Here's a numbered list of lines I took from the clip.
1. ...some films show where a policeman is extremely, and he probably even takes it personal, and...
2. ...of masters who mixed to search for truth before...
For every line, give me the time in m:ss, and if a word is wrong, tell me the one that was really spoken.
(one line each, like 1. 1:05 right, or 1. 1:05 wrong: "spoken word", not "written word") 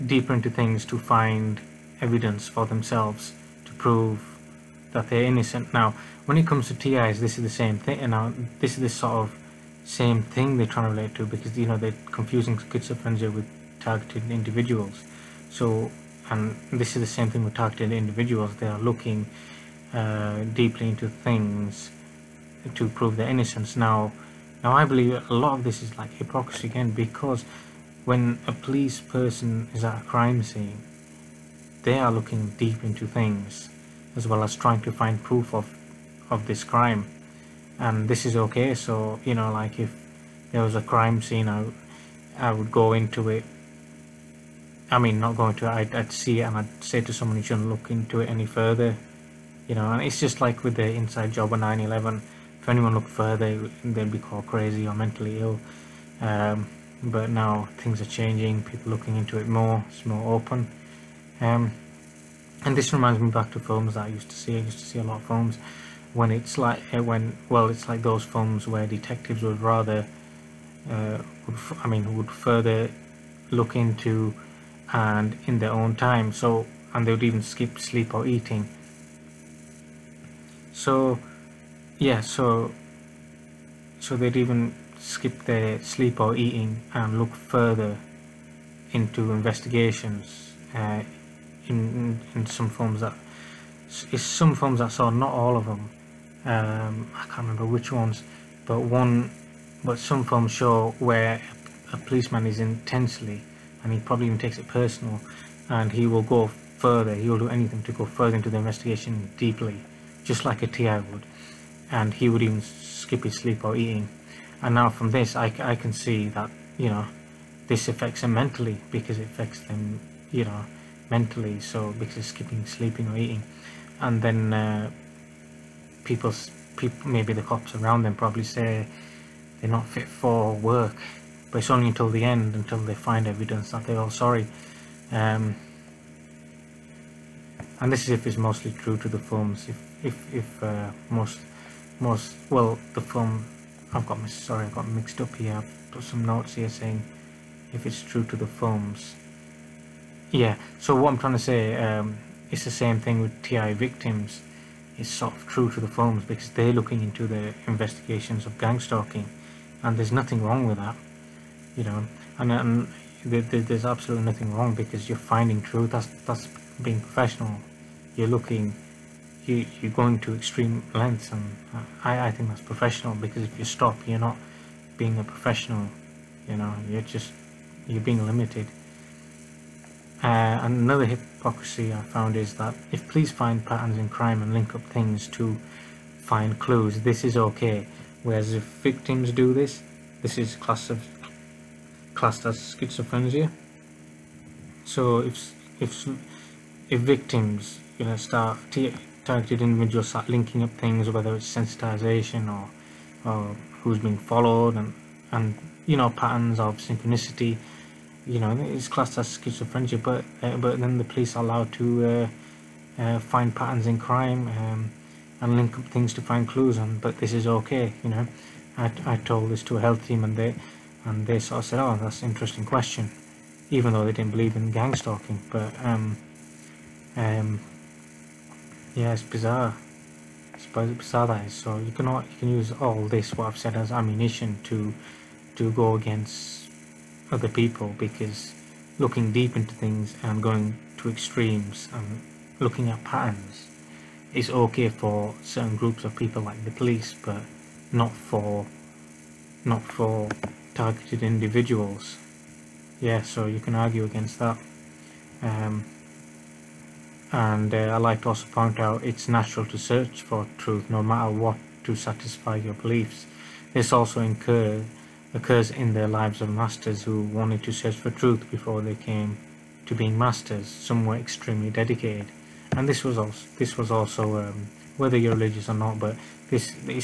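1. 1:39 wrong: "intensely", not "extremely"
2. 4:26 wrong: "wanted", not "mixed".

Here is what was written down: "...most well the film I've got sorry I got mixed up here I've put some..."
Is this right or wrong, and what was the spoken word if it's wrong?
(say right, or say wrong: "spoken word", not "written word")
right.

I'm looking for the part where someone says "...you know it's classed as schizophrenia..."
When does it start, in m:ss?
3:28.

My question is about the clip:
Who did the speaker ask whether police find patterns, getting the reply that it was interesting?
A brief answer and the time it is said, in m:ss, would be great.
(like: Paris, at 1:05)
A health team, at 3:39.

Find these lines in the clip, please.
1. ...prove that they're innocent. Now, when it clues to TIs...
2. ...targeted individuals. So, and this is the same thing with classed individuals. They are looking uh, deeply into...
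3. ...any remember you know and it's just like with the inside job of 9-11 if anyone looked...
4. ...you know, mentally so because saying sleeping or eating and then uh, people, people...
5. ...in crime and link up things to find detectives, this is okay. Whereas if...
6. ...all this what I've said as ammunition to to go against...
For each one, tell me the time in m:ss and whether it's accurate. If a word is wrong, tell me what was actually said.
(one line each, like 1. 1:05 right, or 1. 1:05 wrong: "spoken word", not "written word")
1. 0:03 wrong: "comes", not "clues"
2. 0:13 wrong: "targeted", not "classed"
3. 0:48 wrong: "further", not "remember"
4. 2:00 wrong: "skipping", not "saying"
5. 3:03 wrong: "clues", not "detectives"
6. 3:52 right.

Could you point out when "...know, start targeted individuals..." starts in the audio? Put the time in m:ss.
3:18.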